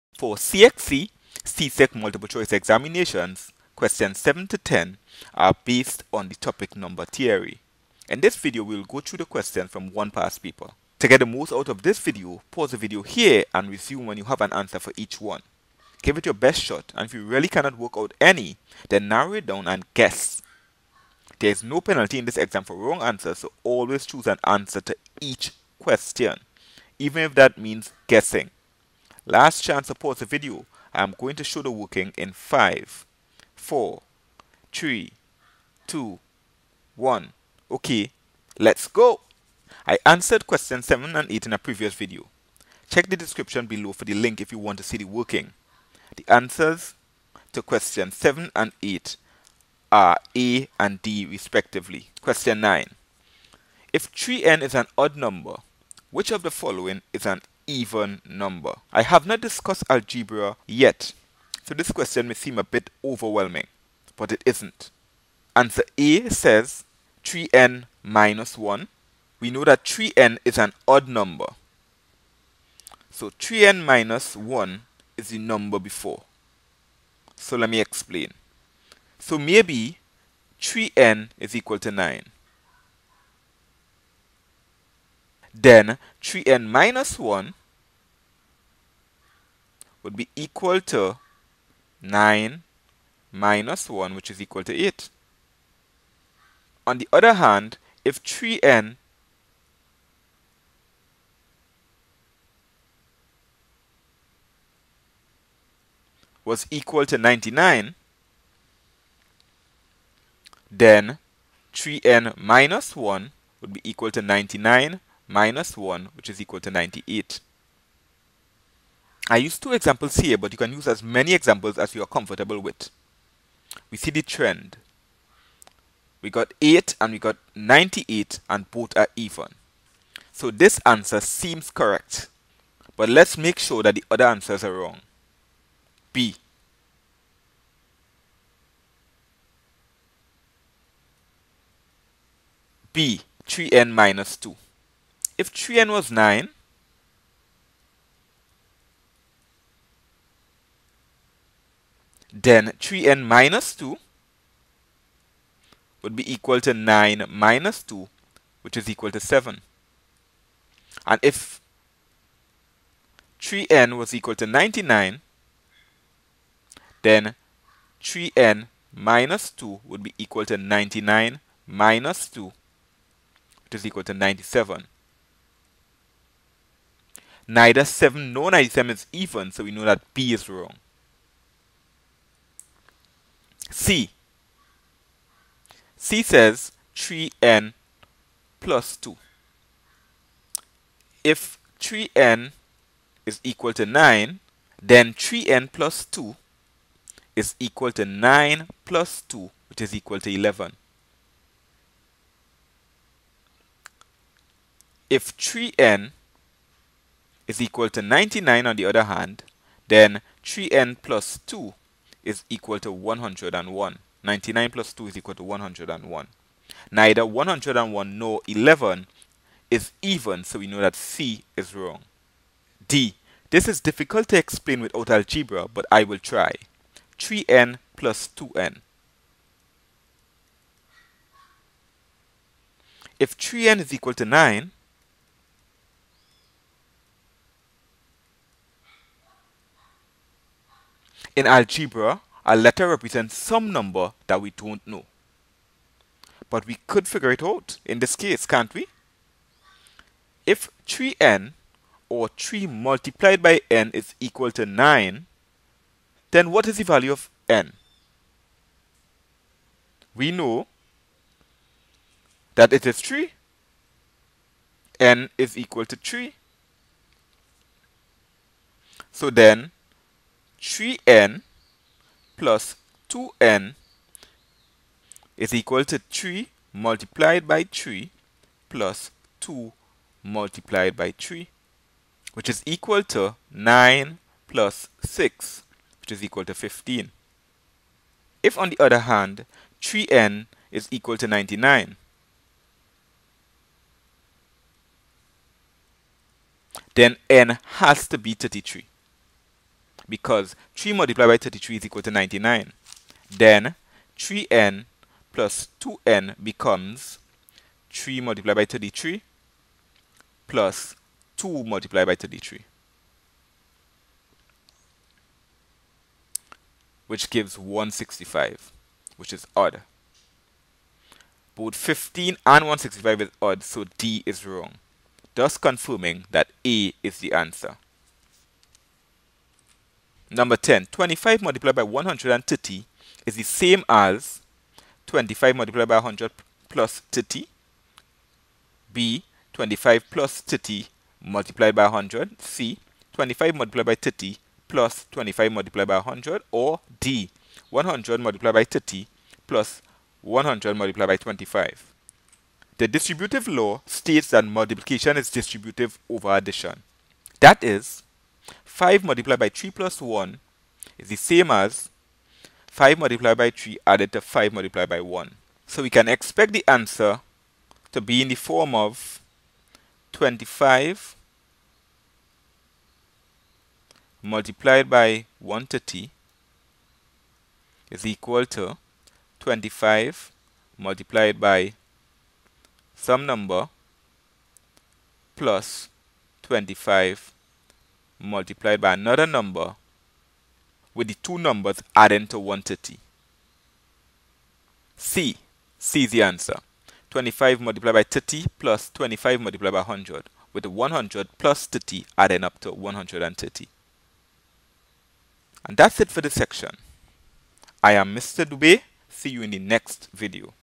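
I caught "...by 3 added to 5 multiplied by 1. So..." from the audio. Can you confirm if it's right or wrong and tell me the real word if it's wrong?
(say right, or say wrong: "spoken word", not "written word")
right.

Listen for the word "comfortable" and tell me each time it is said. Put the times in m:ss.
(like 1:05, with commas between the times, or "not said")
2:02.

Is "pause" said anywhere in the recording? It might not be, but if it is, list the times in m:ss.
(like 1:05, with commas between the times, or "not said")
0:12, 0:29.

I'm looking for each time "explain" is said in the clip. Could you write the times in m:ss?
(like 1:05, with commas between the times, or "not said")
1:17, 3:44.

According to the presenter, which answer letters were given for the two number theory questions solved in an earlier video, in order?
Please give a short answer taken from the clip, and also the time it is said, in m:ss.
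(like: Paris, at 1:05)
A and D, at 0:50.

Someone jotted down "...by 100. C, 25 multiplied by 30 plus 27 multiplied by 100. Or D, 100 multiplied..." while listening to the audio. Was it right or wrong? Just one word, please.
wrong.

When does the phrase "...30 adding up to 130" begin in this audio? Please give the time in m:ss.
6:41.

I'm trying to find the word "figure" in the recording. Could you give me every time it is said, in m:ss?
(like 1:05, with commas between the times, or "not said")
4:07.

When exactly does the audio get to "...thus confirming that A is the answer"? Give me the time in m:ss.
5:25.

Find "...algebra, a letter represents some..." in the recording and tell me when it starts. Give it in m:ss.
4:01.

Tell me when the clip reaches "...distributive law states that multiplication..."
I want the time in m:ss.
5:52.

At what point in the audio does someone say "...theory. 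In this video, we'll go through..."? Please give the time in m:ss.
0:07.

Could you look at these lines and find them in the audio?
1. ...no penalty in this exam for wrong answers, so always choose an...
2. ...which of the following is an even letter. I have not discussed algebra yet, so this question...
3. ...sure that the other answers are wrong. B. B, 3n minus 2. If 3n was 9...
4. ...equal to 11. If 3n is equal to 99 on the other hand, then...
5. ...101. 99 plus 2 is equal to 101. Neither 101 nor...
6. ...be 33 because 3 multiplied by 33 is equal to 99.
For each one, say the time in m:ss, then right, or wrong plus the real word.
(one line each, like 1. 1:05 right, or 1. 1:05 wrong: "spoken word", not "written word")
1. 0:21 right
2. 0:56 wrong: "number", not "letter"
3. 2:13 right
4. 3:19 right
5. 3:32 right
6. 4:58 right.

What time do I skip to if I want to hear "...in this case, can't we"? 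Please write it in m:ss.
4:07.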